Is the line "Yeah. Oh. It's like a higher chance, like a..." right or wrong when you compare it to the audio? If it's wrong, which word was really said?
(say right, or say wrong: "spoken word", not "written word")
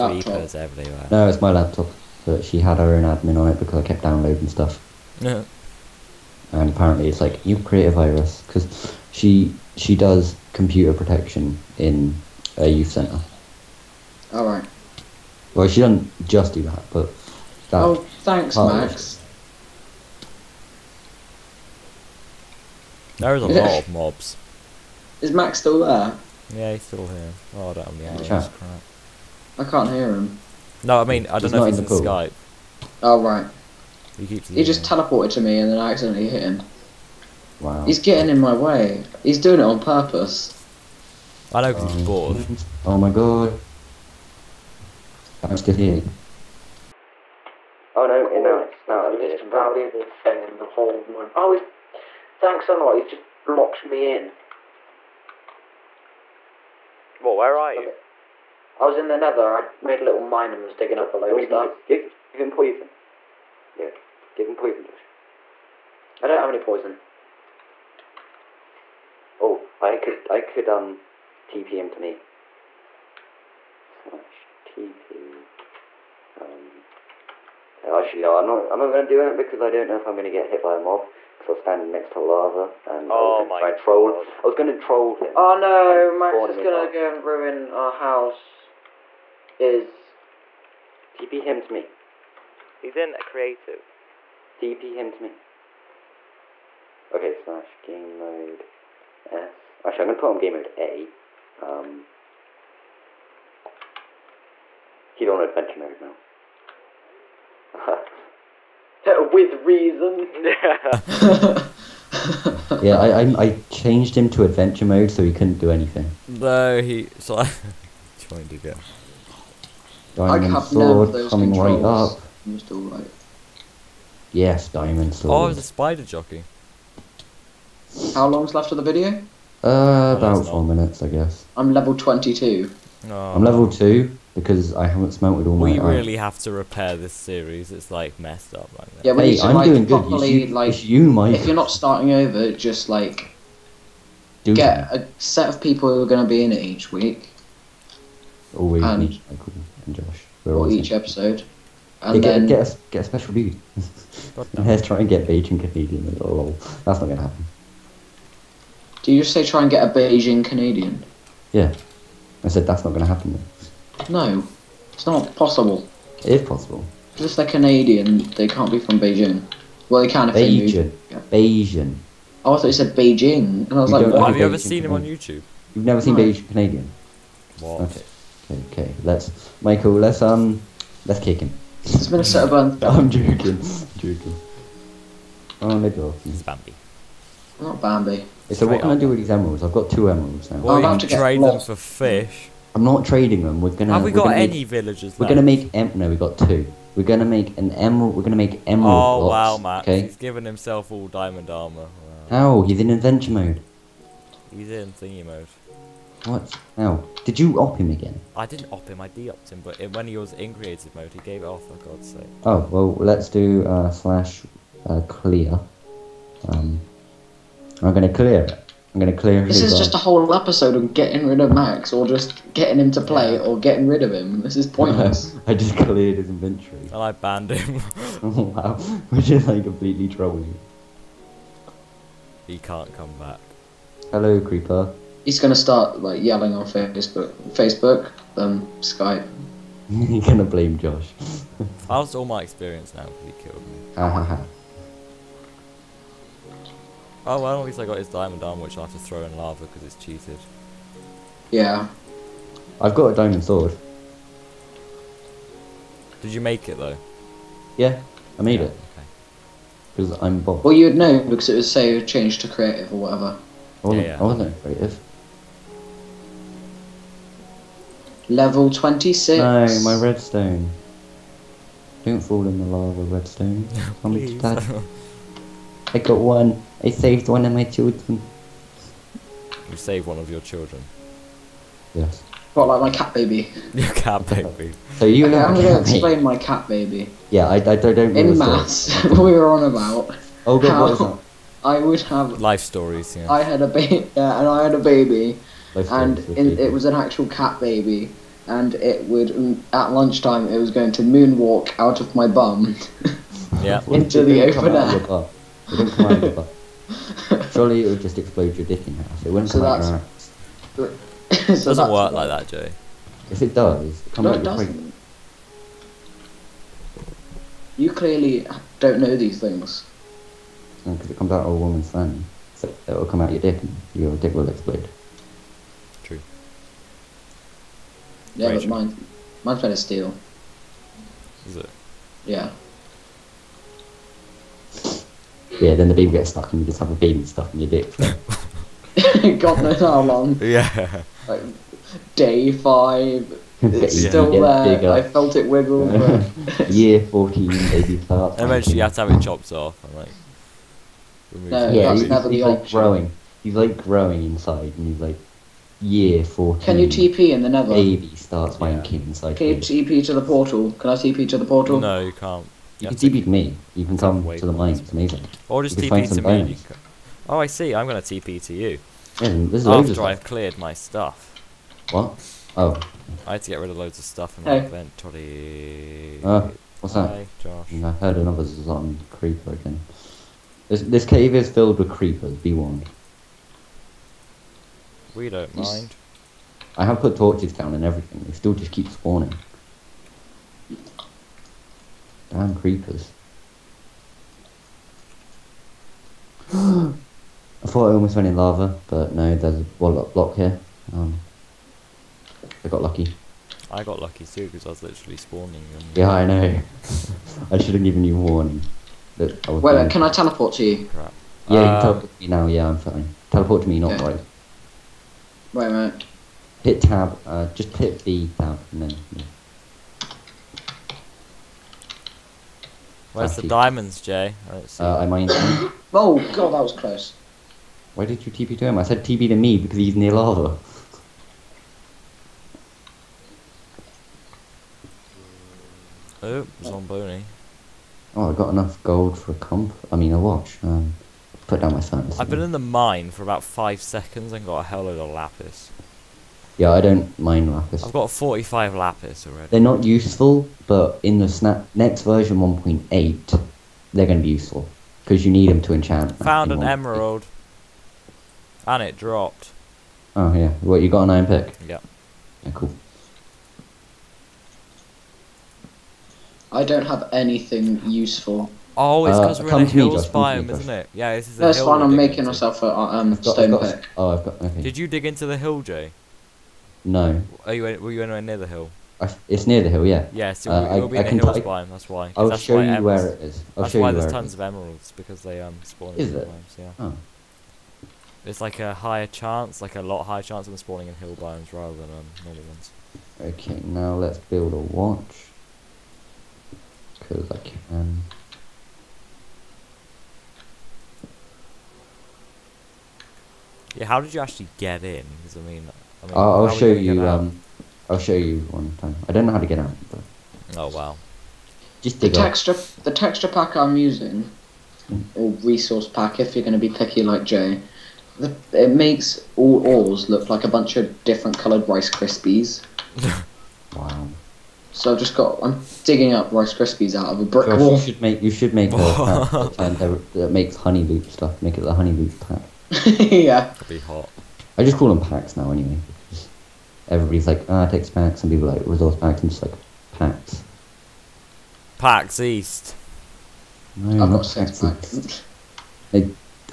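right.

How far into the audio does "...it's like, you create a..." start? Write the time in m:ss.
0:07.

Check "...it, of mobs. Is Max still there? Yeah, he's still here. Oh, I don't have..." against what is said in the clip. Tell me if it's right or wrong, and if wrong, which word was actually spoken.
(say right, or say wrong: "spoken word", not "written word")
right.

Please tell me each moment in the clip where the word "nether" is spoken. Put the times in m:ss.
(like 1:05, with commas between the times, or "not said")
0:59, 5:57.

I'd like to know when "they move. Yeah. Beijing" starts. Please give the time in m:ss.
2:50.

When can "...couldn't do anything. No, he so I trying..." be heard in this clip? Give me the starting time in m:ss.
1:55.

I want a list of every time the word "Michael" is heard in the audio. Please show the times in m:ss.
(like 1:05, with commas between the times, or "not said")
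2:29, 2:59.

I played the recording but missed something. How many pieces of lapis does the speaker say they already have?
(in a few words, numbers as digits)
45.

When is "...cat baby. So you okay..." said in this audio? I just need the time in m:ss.
4:43.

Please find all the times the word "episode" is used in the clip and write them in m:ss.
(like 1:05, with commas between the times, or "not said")
2:30, 3:40.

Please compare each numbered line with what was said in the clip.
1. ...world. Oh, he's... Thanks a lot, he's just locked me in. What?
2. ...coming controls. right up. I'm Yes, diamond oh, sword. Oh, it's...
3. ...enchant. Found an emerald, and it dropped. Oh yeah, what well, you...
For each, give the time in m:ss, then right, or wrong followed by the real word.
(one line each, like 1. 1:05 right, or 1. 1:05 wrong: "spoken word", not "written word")
1. 0:51 right
2. 2:01 right
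3. 7:35 right.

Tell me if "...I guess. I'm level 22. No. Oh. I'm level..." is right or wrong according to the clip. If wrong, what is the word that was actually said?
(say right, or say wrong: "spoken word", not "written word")
right.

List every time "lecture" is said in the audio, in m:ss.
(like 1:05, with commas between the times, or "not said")
not said.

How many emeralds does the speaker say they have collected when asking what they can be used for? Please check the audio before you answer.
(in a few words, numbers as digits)
2.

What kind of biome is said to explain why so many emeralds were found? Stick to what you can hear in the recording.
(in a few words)
Hills biome.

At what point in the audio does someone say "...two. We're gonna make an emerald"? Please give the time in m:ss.
3:16.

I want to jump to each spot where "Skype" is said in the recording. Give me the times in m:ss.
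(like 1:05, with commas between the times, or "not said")
0:31, 3:58.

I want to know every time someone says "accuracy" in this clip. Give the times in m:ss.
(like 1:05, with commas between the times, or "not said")
not said.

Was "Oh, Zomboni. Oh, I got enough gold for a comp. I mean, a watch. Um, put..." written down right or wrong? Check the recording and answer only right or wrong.
right.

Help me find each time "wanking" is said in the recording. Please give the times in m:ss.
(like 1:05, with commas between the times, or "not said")
5:58.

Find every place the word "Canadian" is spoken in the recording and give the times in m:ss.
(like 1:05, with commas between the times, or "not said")
2:35, 2:40, 2:47, 2:56.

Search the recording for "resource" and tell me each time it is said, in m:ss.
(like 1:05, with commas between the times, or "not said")
8:35, 8:58.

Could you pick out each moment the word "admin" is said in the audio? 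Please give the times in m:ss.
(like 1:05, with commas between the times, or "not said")
0:03.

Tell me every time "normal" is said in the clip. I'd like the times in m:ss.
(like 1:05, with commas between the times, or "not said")
8:12.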